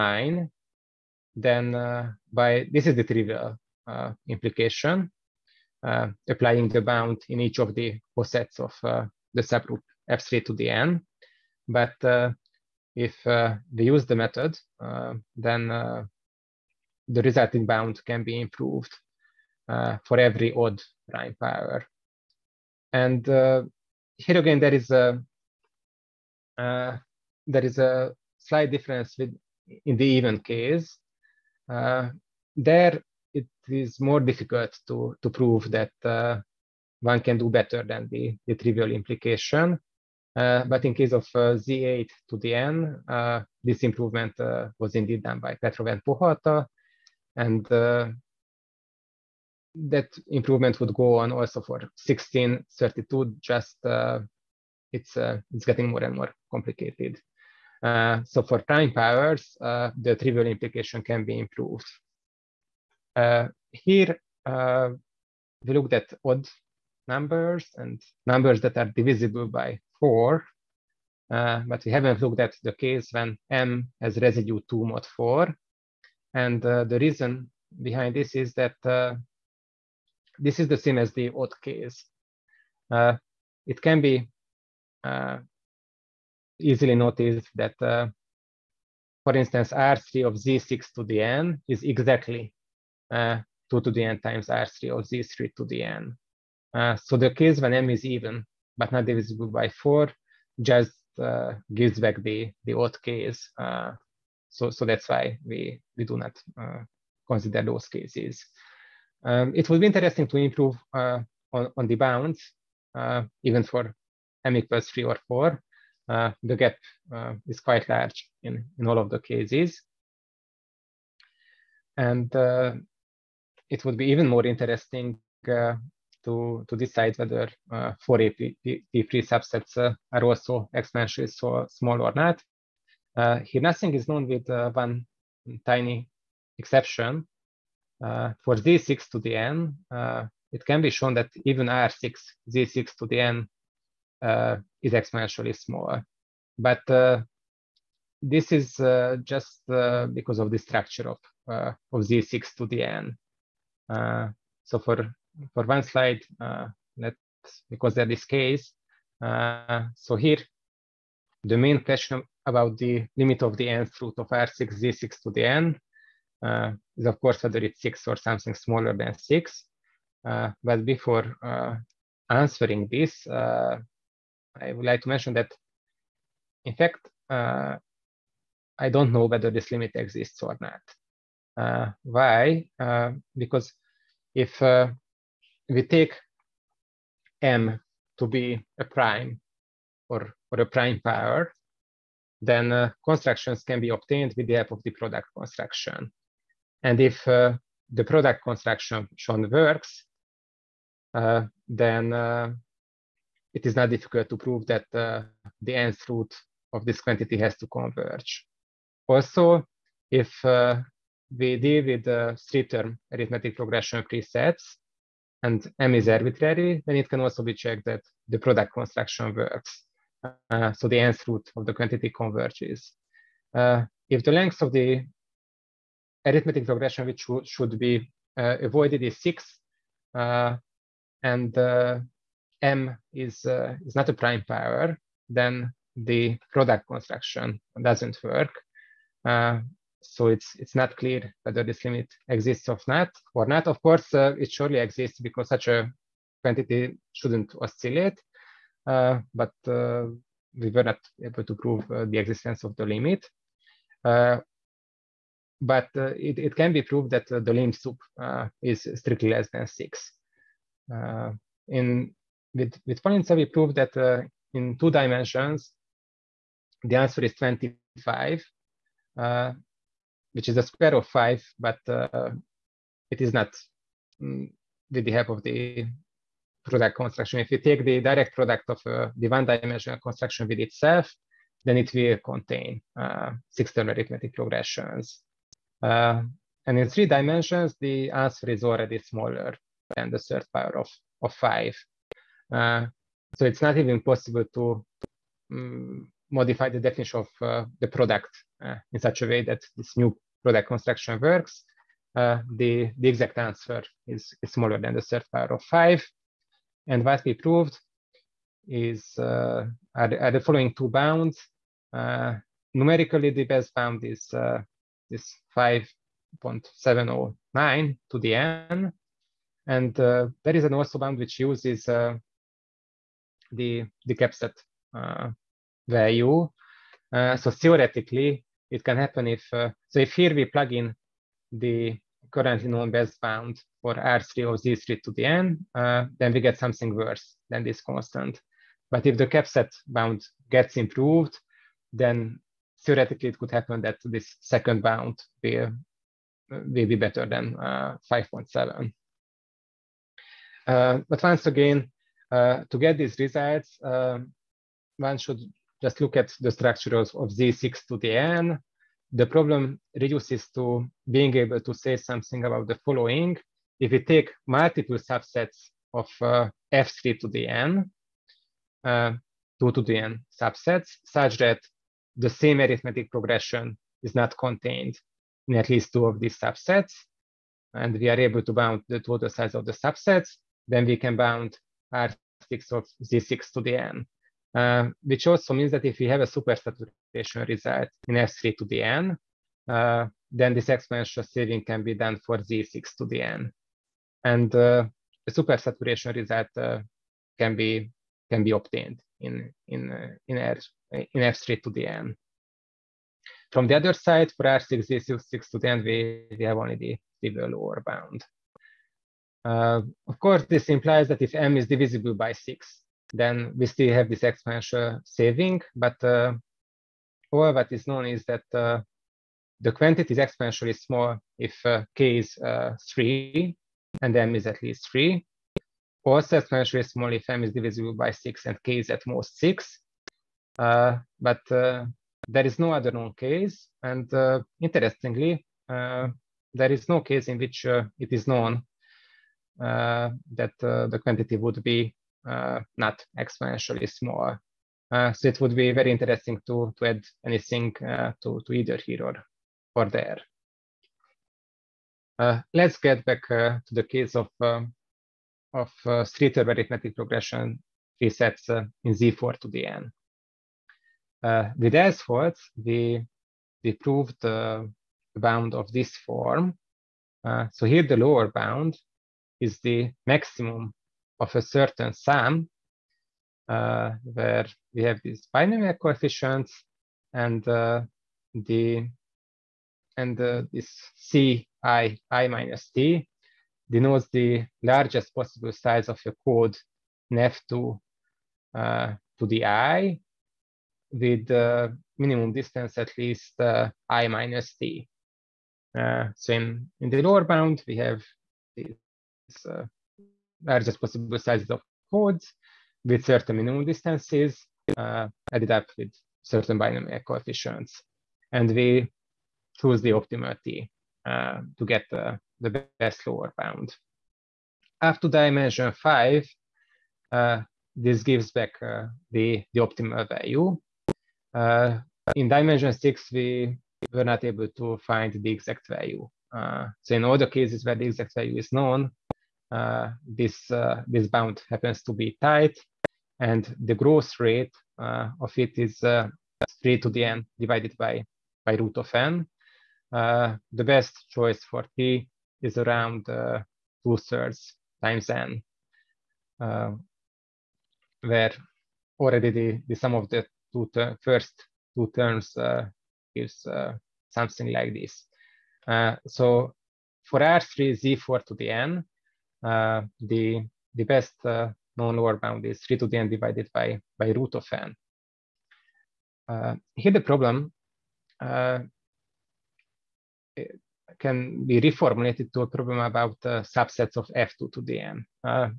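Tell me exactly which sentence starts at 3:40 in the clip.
Uh, so the nth root of the quantity converges.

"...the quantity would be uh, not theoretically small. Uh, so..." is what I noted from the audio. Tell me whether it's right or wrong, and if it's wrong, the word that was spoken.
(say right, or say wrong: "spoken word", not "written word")
wrong: "exponentially", not "theoretically".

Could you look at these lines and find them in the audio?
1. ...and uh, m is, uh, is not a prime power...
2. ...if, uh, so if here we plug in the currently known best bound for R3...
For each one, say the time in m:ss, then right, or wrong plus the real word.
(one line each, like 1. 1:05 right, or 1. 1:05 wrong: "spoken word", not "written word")
1. 3:51 right
2. 5:29 right.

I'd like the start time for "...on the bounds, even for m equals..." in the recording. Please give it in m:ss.
1:51.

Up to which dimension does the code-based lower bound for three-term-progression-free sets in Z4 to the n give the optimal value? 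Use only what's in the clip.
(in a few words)
5.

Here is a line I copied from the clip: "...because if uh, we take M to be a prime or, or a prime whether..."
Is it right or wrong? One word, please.
wrong.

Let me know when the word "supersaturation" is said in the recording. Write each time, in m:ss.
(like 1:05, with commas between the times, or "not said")
6:26, 6:35.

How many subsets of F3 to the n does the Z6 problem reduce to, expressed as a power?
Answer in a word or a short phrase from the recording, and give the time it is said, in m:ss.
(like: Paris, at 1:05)
2 to the n, at 6:09.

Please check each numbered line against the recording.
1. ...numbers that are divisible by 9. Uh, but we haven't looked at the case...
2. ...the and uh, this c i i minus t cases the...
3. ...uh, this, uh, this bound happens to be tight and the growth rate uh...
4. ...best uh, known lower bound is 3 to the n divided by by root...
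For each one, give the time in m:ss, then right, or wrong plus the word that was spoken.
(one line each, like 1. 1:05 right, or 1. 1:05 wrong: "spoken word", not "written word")
1. 1:08 wrong: "4", not "9"
2. 7:58 wrong: "denotes", not "cases"
3. 8:49 right
4. 9:20 right.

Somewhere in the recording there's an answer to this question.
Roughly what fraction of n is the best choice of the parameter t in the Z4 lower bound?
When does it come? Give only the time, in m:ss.
9:03.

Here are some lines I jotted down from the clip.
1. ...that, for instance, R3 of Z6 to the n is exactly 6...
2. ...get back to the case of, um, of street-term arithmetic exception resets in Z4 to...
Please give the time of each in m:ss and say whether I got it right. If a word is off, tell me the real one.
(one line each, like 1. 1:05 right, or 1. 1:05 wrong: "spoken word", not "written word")
1. 1:27 wrong: "2", not "6"
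2. 7:32 wrong: "progression", not "exception".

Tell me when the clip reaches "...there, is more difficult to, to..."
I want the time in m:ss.
0:32.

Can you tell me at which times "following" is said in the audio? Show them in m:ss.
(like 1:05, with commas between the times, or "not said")
5:10, 6:02.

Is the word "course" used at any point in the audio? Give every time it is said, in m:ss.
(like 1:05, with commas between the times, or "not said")
2:47, 4:03, 6:50.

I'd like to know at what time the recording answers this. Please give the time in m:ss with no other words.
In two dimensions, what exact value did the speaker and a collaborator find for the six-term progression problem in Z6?
4:27.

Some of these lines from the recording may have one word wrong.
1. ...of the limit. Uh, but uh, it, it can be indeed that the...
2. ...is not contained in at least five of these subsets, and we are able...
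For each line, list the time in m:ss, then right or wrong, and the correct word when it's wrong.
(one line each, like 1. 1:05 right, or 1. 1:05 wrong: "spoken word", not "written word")
1. 4:12 wrong: "proved", not "indeed"
2. 6:14 wrong: "two", not "five".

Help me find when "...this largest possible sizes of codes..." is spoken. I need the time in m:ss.
8:18.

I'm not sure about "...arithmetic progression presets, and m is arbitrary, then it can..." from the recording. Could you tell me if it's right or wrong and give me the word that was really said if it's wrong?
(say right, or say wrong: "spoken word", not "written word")
right.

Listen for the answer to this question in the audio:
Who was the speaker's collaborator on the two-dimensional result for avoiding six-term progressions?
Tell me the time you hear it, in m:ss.
4:23.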